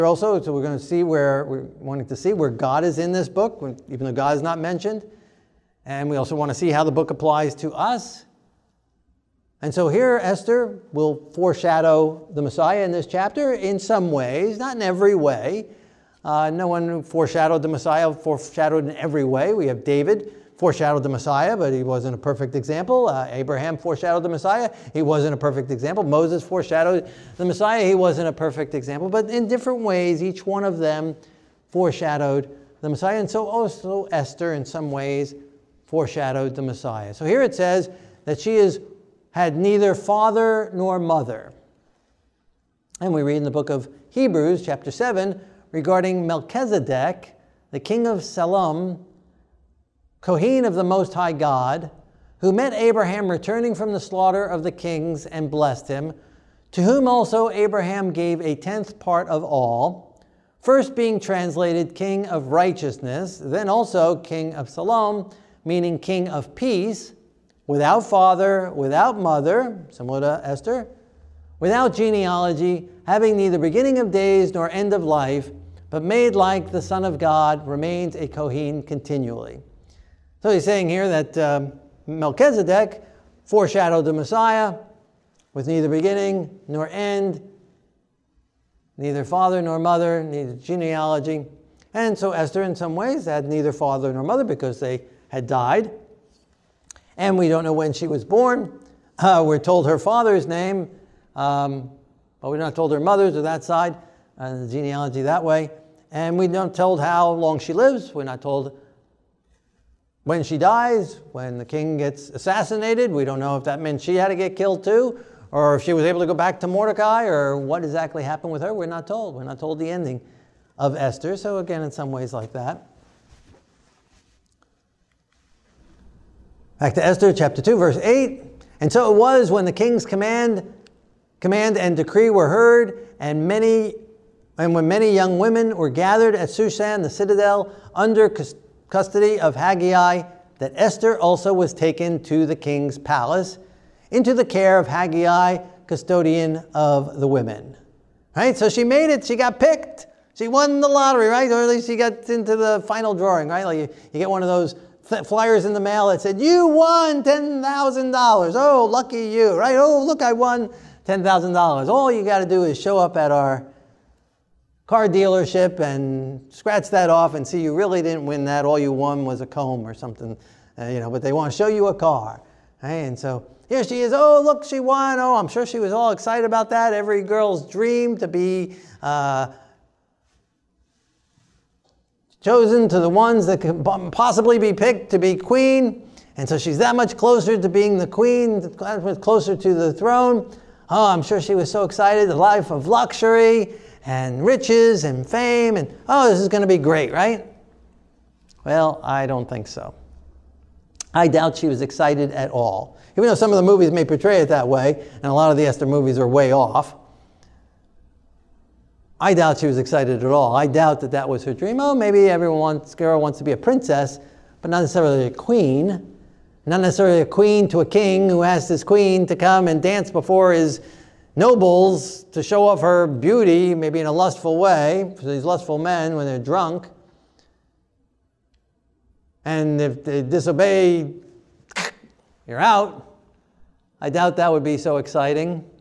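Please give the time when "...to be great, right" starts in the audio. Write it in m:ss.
3:16.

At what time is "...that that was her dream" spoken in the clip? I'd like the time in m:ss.
3:31.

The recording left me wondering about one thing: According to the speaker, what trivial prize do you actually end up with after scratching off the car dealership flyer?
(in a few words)
A comb.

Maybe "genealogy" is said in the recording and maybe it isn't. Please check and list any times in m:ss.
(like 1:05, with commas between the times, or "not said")
1:11, 1:30, 1:44.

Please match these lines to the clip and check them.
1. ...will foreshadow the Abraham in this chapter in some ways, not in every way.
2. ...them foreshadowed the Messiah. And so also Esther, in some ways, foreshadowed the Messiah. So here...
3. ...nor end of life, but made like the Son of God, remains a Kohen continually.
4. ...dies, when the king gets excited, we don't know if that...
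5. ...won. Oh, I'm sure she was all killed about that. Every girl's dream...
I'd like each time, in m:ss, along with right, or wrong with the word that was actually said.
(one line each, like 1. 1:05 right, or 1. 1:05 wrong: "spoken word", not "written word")
1. 0:10 wrong: "Messiah", not "Abraham"
2. 0:30 right
3. 1:14 right
4. 1:50 wrong: "assassinated", not "excited"
5. 2:54 wrong: "excited", not "killed".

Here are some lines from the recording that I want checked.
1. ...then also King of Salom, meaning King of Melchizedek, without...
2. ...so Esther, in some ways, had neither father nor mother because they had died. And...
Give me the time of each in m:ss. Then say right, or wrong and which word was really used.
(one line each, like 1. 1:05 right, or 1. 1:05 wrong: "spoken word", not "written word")
1. 1:03 wrong: "Peace", not "Melchizedek"
2. 1:32 right.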